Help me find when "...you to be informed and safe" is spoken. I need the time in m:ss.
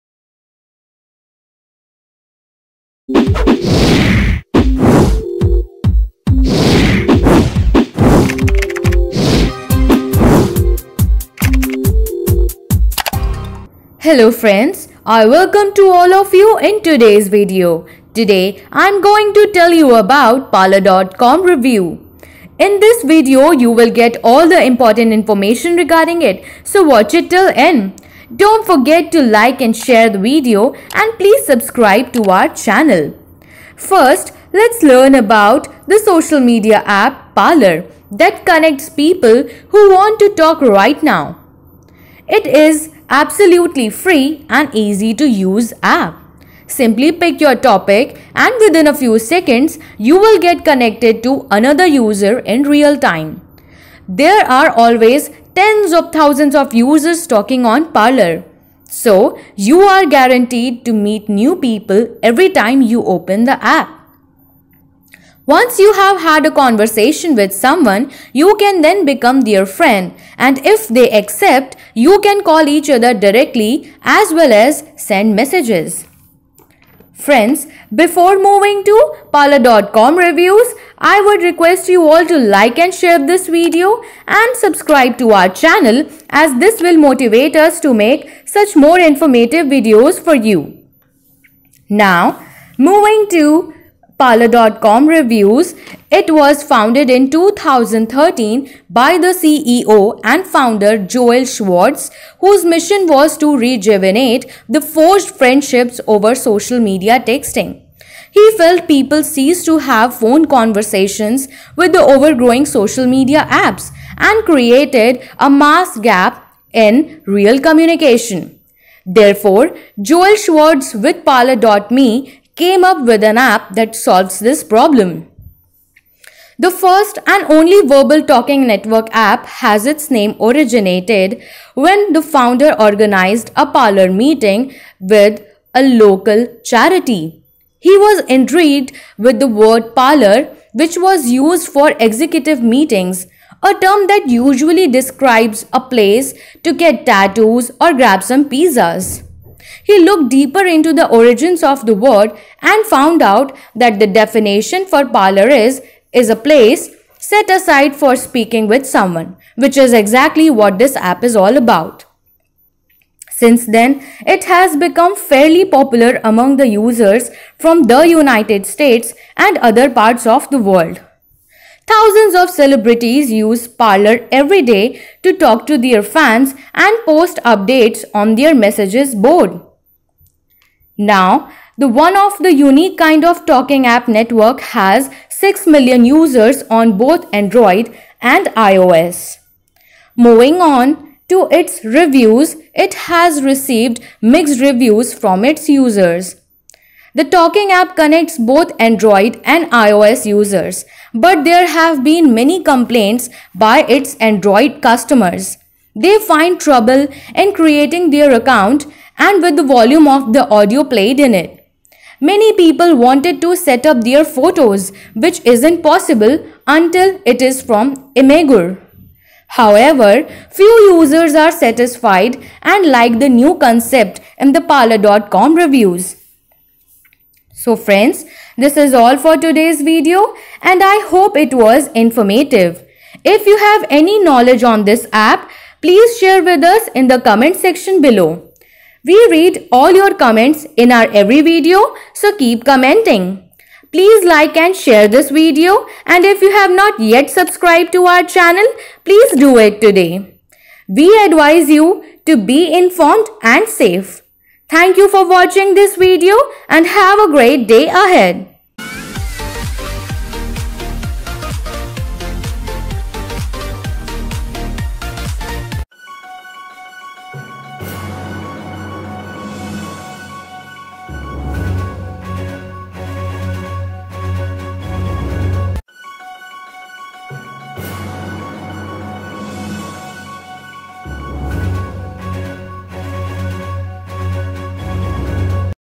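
4:11.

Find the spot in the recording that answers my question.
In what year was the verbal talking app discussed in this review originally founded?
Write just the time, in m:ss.
1:37.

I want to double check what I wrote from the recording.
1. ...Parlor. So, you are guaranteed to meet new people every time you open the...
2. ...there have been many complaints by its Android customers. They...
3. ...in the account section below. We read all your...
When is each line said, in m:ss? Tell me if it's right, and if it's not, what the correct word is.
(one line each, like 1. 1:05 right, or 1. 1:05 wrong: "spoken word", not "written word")
1. 0:57 right
2. 3:21 right
3. 3:56 wrong: "comment", not "account".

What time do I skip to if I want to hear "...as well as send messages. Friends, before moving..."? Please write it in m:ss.
1:14.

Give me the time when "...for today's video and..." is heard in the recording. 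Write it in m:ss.
3:49.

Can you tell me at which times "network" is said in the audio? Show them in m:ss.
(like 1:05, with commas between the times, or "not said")
2:08, 3:04.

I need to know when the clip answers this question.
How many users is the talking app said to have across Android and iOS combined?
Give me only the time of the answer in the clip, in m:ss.
3:05.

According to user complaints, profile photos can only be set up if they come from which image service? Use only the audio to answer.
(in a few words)
Imgur.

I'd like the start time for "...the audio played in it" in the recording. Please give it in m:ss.
3:30.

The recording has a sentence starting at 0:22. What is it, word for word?
In this video, you will get all the important information regarding it, so watch it till end.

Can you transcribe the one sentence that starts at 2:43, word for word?
Since then, it has become fairly popular among the users from the United States and other parts of the world.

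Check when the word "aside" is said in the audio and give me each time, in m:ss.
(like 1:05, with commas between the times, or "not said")
2:37.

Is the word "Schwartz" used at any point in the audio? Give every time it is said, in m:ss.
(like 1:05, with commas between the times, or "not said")
1:41, 2:00.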